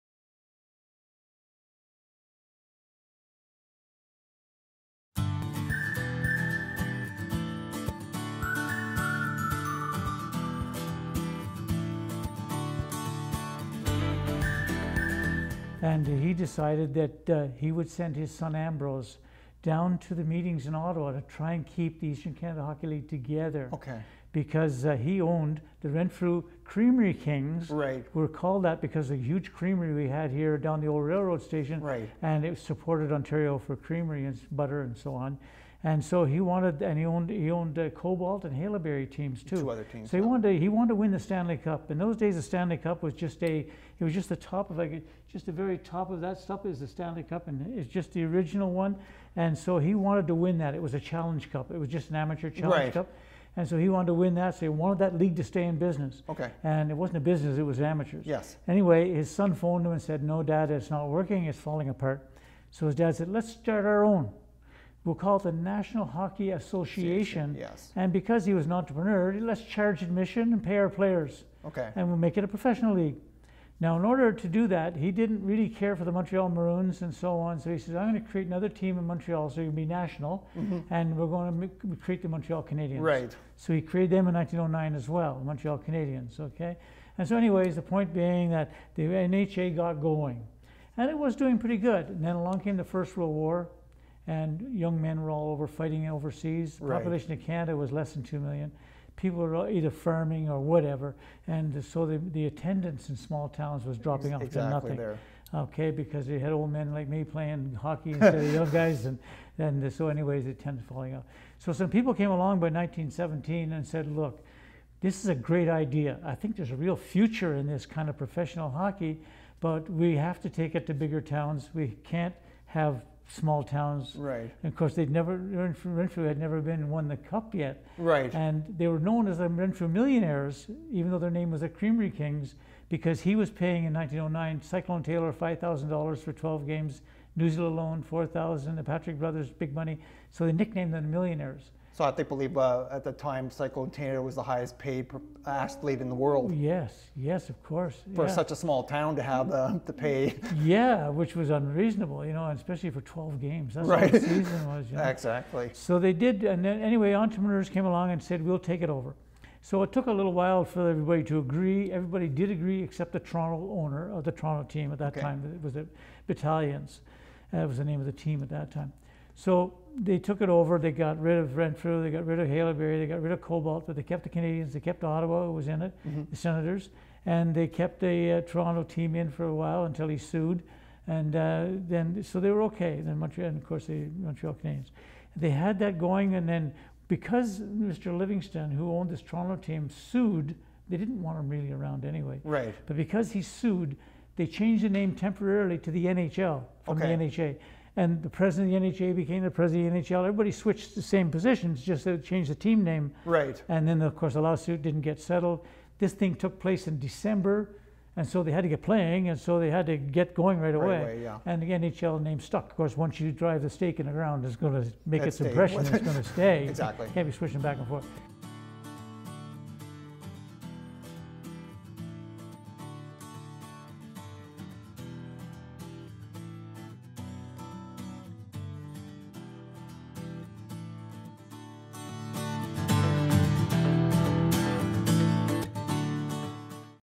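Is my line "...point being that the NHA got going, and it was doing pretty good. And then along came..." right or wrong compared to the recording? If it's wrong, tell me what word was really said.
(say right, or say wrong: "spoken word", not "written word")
right.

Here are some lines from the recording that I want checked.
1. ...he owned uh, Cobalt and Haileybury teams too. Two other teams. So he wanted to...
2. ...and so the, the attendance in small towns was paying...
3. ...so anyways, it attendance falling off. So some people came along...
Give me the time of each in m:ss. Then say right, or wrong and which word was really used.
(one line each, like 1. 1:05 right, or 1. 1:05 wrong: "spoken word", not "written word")
1. 0:37 right
2. 1:41 wrong: "dropping", not "paying"
3. 1:49 right.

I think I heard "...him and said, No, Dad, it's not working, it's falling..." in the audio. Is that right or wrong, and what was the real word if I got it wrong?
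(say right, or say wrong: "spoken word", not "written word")
right.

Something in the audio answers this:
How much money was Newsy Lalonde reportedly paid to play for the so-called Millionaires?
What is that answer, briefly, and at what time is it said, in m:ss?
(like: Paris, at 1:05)
$4,000, at 2:18.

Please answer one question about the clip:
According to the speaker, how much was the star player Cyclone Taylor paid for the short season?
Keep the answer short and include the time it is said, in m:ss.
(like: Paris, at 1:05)
$5,000, at 2:15.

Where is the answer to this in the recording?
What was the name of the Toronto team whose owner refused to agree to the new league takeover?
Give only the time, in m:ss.
2:46.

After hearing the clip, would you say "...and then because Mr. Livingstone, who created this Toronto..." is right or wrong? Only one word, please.
wrong.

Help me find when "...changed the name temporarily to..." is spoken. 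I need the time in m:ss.
3:14.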